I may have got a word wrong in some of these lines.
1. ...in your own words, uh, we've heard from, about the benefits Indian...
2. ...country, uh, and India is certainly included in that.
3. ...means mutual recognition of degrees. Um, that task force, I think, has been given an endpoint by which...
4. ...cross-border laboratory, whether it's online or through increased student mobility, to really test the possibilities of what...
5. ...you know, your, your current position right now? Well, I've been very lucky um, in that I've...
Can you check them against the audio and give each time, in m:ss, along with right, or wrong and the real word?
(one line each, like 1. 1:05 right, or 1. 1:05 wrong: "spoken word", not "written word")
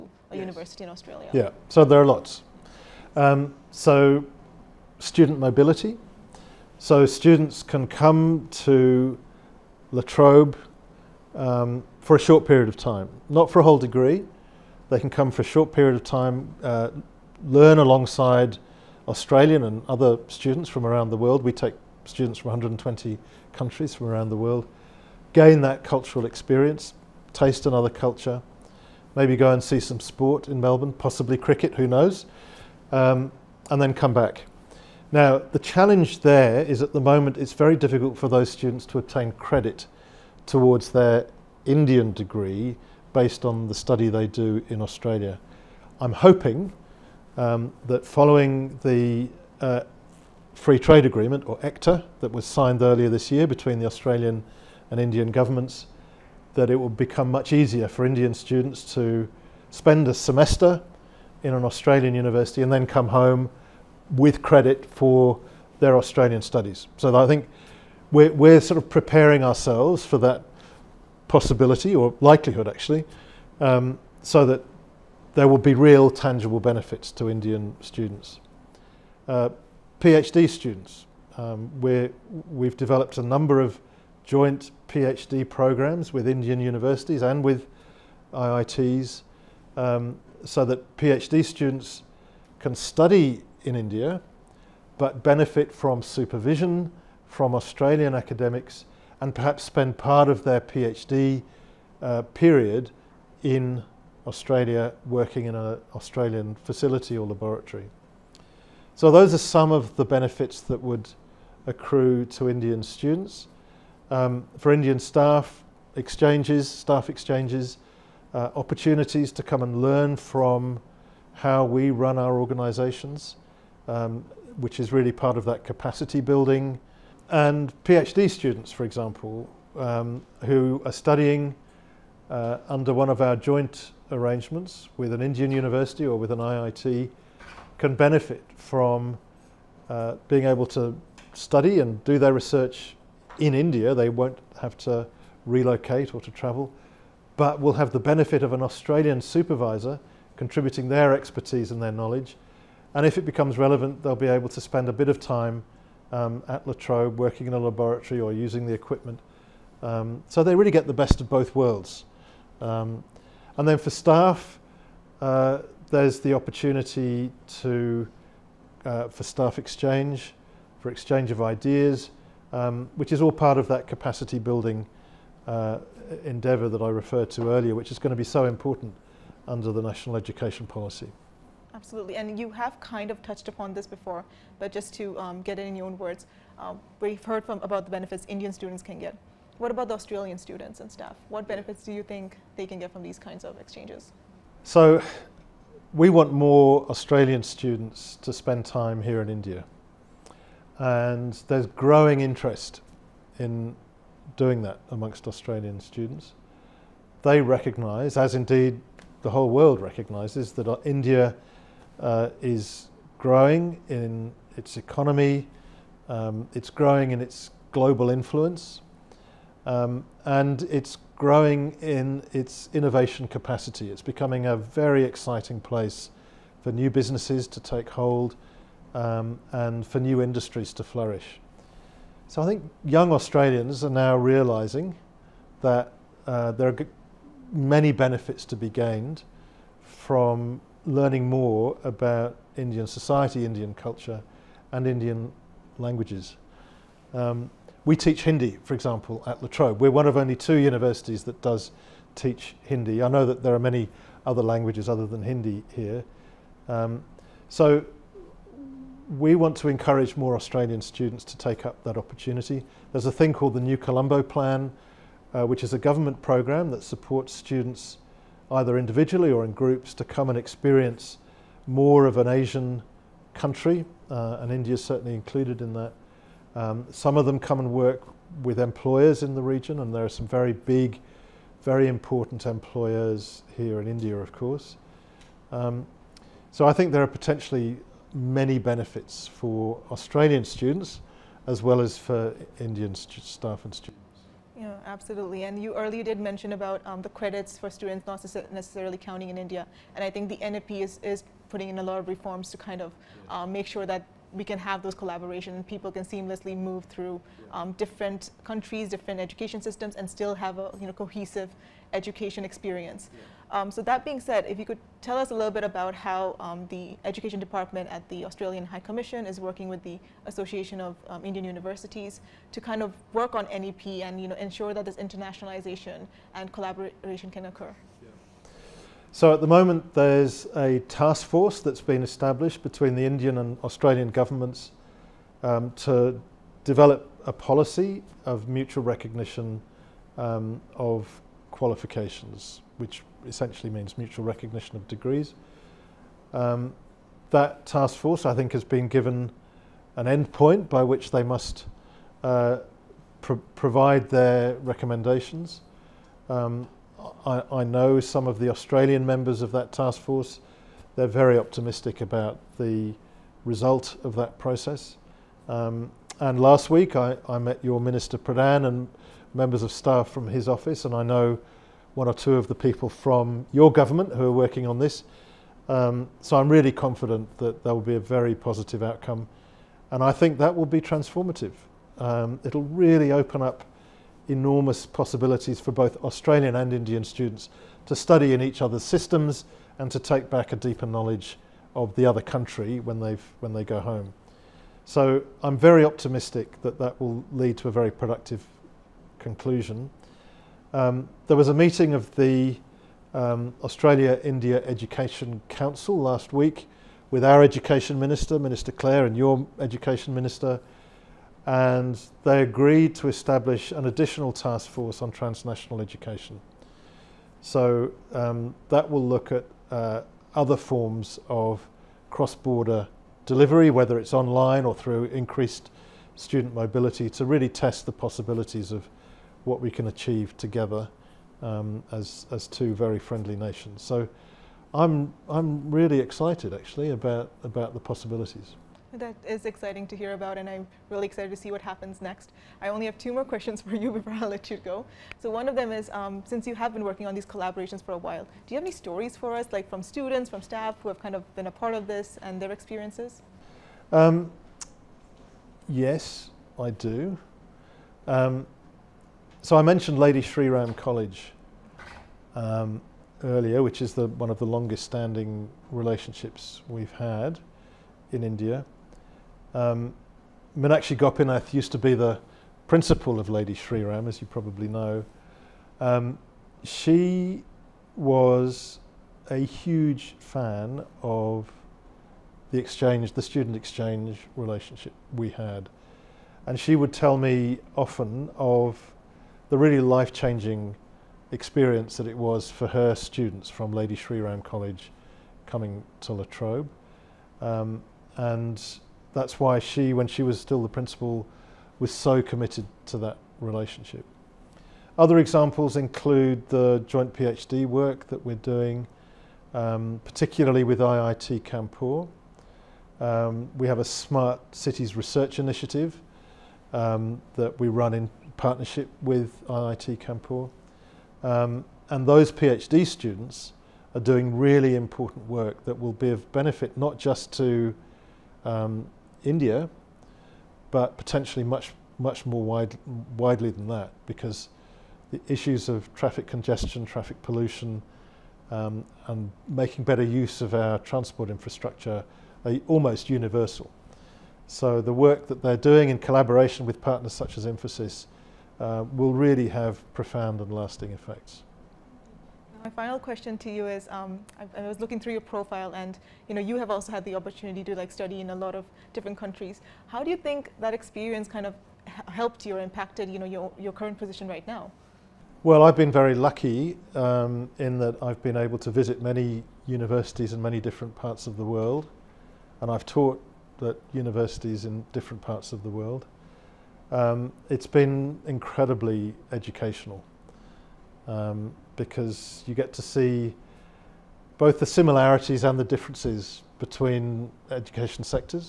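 1. 3:05 right
2. 4:33 right
3. 5:43 right
4. 7:02 wrong: "delivery", not "laboratory"
5. 9:23 right.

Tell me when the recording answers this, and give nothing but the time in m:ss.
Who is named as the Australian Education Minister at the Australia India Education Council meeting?
6:48.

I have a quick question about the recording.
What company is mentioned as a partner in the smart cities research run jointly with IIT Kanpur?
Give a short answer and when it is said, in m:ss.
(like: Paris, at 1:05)
Infosys, at 9:07.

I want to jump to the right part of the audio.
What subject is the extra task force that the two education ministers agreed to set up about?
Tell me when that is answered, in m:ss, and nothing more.
6:55.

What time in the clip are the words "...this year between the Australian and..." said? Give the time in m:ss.
0:53.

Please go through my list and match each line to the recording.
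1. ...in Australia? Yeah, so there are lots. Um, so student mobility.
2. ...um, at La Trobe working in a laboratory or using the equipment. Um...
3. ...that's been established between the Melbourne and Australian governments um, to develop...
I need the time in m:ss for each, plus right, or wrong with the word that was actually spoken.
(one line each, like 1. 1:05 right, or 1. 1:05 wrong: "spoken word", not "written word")
1. 0:00 right
2. 2:36 right
3. 5:31 wrong: "Indian", not "Melbourne".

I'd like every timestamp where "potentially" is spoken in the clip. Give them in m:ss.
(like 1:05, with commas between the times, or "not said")
4:47, 8:50.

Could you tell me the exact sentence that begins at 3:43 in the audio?
It's becoming a very exciting place for new businesses to take hold um, and for new industries to flourish.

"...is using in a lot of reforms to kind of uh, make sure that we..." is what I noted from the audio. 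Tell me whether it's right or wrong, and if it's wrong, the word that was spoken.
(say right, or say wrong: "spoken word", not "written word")
wrong: "putting", not "using".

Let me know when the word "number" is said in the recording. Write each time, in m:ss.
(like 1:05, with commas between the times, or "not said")
1:23.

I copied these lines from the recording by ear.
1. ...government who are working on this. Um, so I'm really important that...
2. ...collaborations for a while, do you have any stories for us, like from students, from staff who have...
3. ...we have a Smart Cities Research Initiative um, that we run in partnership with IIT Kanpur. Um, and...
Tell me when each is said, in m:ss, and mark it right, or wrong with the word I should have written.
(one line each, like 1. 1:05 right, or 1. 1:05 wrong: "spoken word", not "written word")
1. 6:13 wrong: "confident", not "important"
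2. 7:27 right
3. 8:33 right.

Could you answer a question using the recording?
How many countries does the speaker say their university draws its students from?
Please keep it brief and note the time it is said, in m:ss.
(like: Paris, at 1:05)
120, at 0:22.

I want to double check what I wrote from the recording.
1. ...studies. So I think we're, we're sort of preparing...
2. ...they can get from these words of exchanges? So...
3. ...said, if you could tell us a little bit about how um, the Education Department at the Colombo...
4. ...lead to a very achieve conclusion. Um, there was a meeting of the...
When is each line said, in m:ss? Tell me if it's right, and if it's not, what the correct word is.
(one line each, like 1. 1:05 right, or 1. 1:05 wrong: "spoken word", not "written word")
1. 1:06 right
2. 3:12 wrong: "kinds", not "words"
3. 5:14 wrong: "Australian", not "Colombo"
4. 6:37 wrong: "productive", not "achieve".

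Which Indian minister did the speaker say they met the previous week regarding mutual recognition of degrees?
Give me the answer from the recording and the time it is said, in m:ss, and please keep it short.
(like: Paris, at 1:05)
Minister Pradhan, at 6:07.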